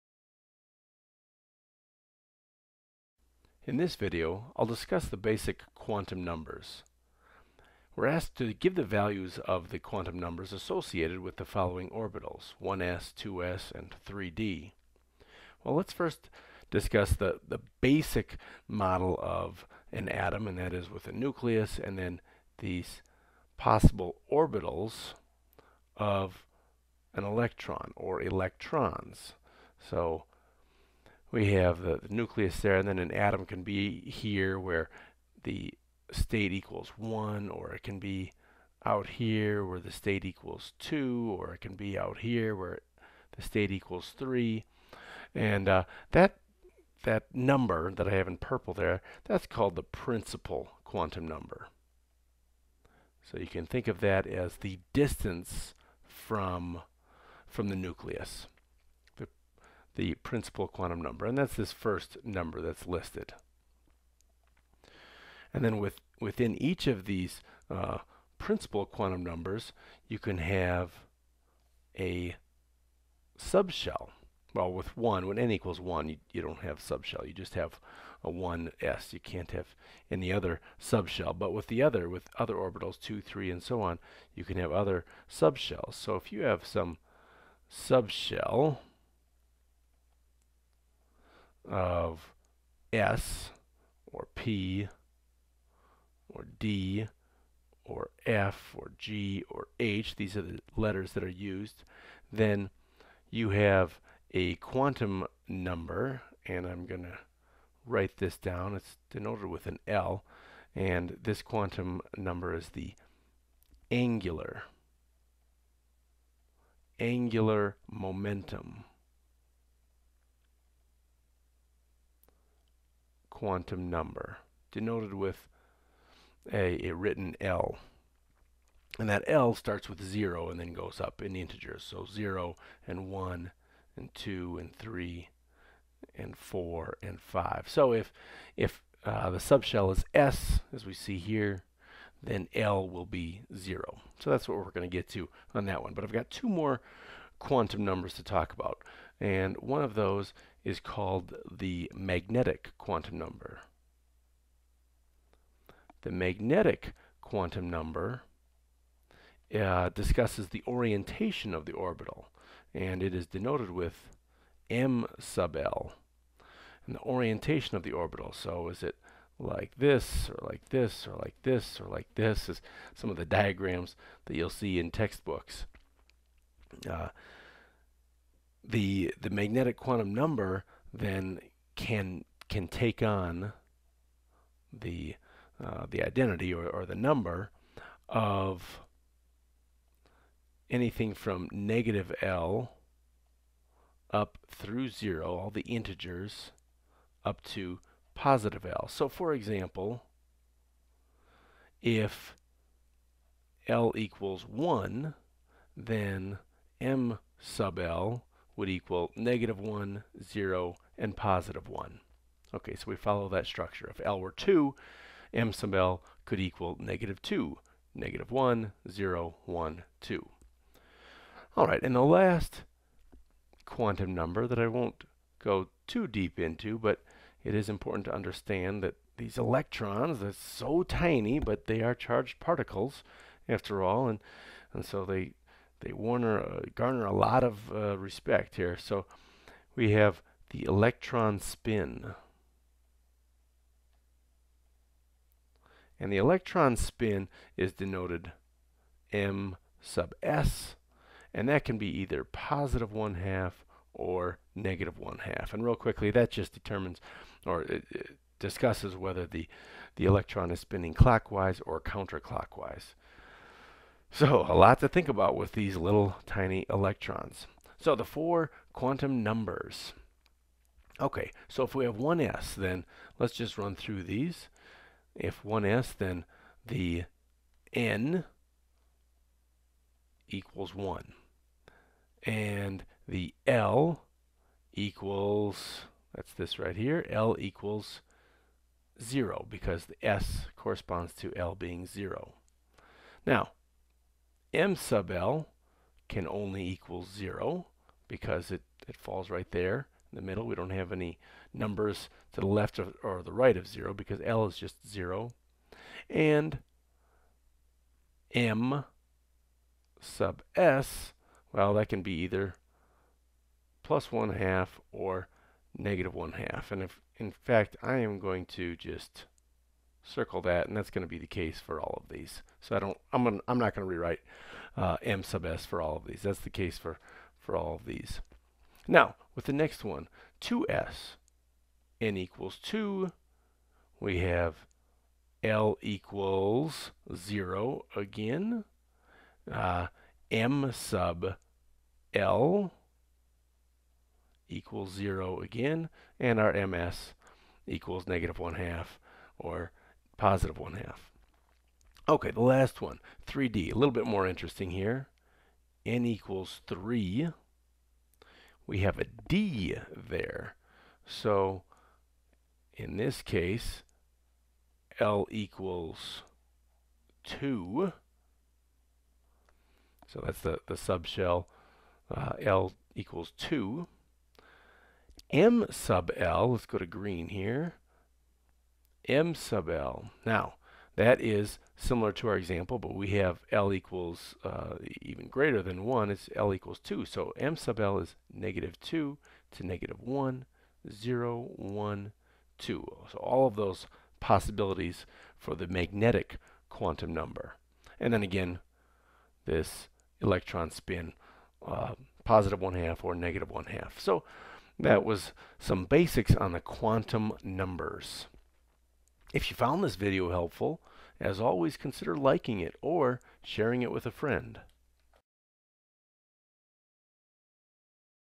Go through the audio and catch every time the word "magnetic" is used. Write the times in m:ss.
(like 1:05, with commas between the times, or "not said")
2:31, 2:36, 2:59, 6:35.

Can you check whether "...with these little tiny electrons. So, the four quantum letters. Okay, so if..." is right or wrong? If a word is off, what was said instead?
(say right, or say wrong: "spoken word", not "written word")
wrong: "numbers", not "letters".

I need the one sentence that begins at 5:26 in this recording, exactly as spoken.
That's the case for, for all of these.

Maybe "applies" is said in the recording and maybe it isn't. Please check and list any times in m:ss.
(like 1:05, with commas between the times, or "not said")
not said.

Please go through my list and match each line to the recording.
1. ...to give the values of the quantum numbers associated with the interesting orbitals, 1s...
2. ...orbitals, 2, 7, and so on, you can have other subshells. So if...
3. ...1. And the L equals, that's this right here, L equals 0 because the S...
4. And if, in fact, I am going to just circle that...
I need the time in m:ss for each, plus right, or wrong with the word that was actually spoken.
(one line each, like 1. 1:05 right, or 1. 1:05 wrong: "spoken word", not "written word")
1. 0:08 wrong: "following", not "interesting"
2. 1:22 wrong: "3", not "7"
3. 4:40 right
4. 5:16 right.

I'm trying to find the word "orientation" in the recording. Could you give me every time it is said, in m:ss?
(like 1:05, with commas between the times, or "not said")
2:40, 2:47.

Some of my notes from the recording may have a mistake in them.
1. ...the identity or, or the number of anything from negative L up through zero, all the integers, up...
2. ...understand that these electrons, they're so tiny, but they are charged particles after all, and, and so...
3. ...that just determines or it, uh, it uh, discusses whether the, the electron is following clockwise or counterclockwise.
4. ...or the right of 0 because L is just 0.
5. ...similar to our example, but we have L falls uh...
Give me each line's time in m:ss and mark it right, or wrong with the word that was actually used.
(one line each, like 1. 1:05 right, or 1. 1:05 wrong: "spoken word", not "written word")
1. 3:05 right
2. 3:48 right
3. 4:16 wrong: "spinning", not "following"
4. 5:03 right
5. 6:21 wrong: "equals", not "falls".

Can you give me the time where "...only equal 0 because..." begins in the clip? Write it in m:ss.
4:56.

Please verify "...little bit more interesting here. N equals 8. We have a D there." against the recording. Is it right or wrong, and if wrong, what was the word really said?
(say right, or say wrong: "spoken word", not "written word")
wrong: "3", not "8".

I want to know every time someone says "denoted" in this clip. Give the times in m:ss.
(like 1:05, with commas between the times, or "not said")
1:49, 2:04, 2:43, 4:07.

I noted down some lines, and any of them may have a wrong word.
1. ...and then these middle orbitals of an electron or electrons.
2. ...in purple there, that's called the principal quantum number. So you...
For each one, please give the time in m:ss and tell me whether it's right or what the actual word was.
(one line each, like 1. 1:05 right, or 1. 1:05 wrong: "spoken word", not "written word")
1. 0:21 wrong: "possible", not "middle"
2. 0:48 right.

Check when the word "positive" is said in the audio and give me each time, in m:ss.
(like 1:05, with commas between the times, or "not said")
3:18, 3:31, 4:12, 5:50, 6:42.